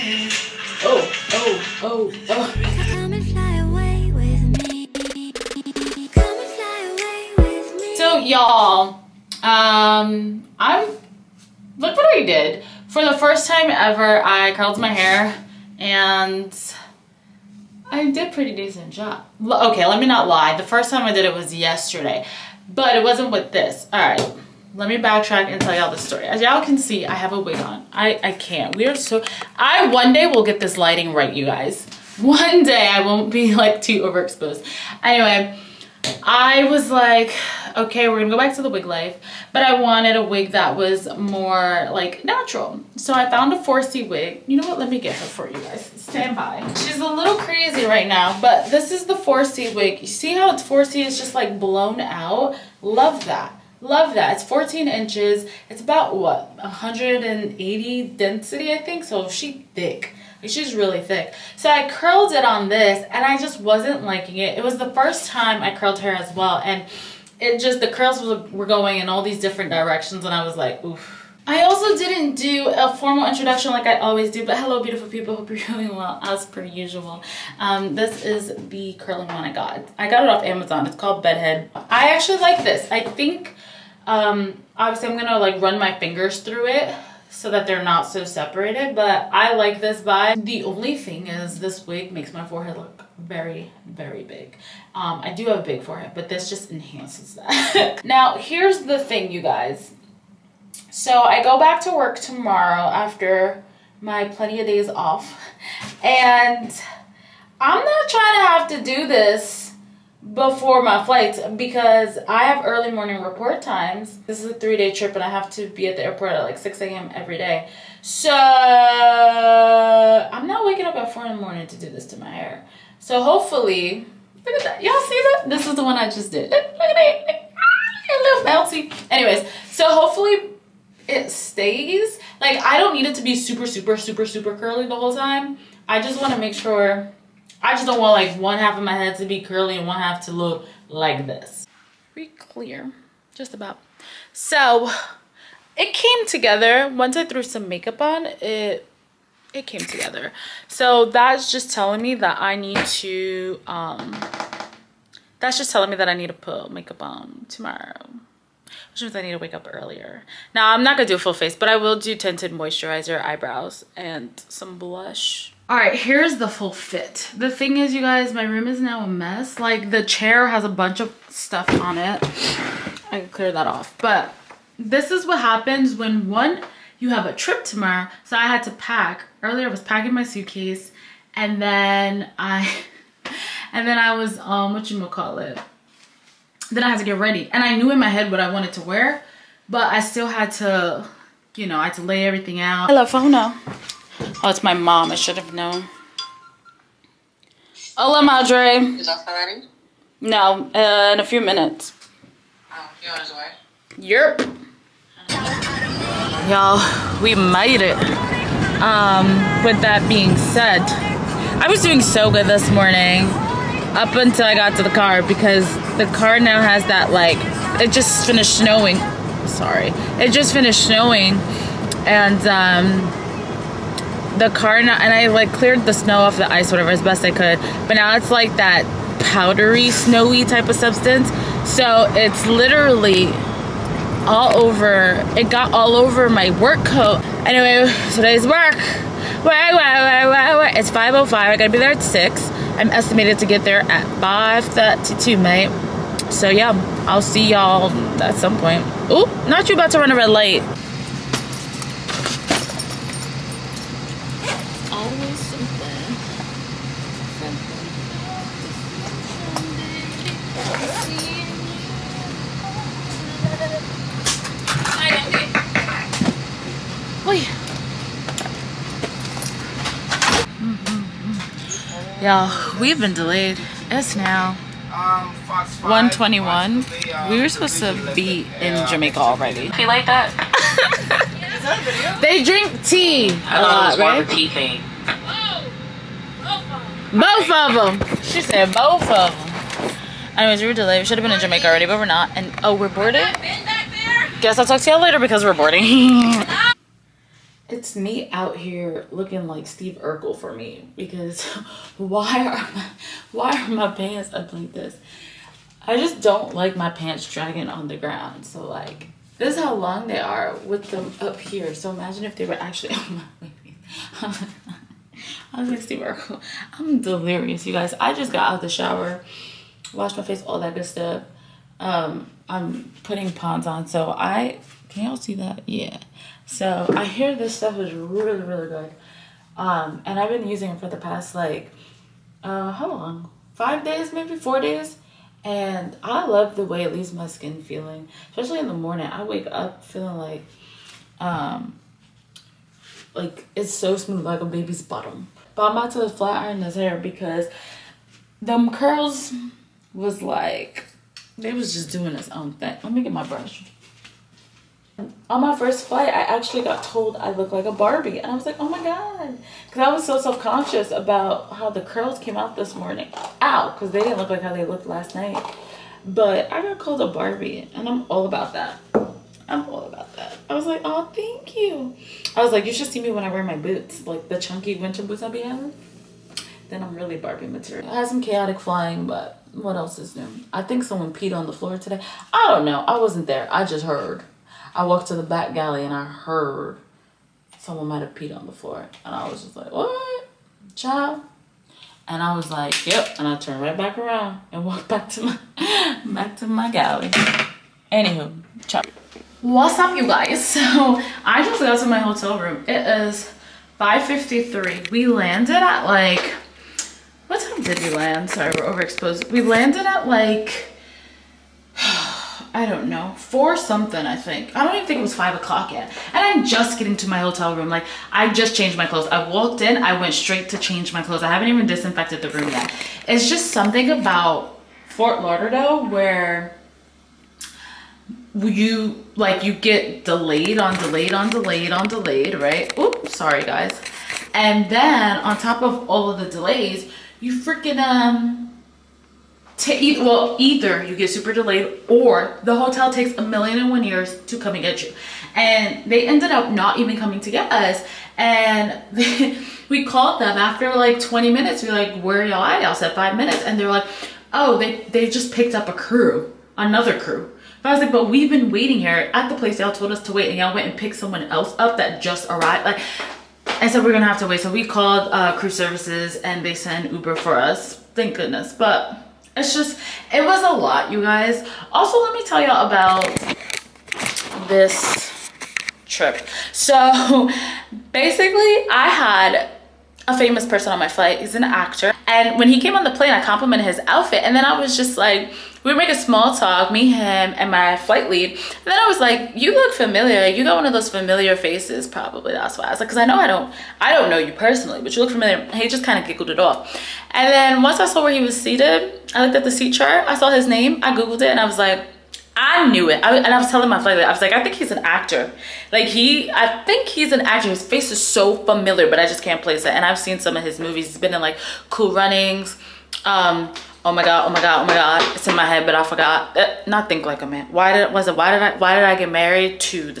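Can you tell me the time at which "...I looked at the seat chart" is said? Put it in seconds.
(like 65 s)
499 s.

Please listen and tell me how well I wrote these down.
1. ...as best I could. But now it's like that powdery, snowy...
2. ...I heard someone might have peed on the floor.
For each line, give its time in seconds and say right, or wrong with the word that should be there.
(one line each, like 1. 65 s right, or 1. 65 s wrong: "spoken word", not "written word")
1. 226 s right
2. 385 s right.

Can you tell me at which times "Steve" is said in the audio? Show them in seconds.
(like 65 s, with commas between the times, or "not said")
299 s, 315 s.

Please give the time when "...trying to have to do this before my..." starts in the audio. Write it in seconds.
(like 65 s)
108 s.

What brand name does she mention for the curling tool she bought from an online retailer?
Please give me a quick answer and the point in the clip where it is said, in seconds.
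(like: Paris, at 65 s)
Bedhead, at 81 s.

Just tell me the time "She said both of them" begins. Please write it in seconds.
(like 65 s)
288 s.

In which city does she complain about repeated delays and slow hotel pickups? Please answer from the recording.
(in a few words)
Fort Lauderdale.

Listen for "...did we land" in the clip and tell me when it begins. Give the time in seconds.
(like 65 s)
407 s.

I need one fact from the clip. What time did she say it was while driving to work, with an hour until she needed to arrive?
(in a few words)
5:05.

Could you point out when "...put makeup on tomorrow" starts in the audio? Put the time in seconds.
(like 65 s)
156 s.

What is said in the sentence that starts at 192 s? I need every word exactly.
Hello, phone Oh, it's my mom.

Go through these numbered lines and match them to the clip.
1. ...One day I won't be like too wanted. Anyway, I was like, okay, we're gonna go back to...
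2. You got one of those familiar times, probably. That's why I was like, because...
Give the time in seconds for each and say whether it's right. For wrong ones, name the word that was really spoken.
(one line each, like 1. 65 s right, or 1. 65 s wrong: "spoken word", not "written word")
1. 32 s wrong: "overexposed", not "wanted"
2. 490 s wrong: "faces", not "times".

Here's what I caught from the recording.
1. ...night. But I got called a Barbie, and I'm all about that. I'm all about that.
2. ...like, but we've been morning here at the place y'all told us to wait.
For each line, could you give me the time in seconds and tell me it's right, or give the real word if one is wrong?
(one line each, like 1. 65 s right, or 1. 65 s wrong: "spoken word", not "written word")
1. 365 s right
2. 457 s wrong: "waiting", not "morning".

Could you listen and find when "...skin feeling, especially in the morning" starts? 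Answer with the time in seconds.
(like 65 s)
337 s.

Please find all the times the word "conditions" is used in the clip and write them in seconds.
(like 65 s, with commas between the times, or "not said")
not said.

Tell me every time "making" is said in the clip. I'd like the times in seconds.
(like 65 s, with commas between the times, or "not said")
485 s.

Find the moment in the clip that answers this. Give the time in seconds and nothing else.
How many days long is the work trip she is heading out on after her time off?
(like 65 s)
114 s.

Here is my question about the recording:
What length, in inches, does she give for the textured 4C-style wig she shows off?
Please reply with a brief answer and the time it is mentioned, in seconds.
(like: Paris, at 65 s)
14 inches, at 54 s.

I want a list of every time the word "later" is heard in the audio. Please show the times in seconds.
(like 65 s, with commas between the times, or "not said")
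295 s.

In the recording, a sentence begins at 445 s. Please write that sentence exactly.
And they ended up not even coming to get us.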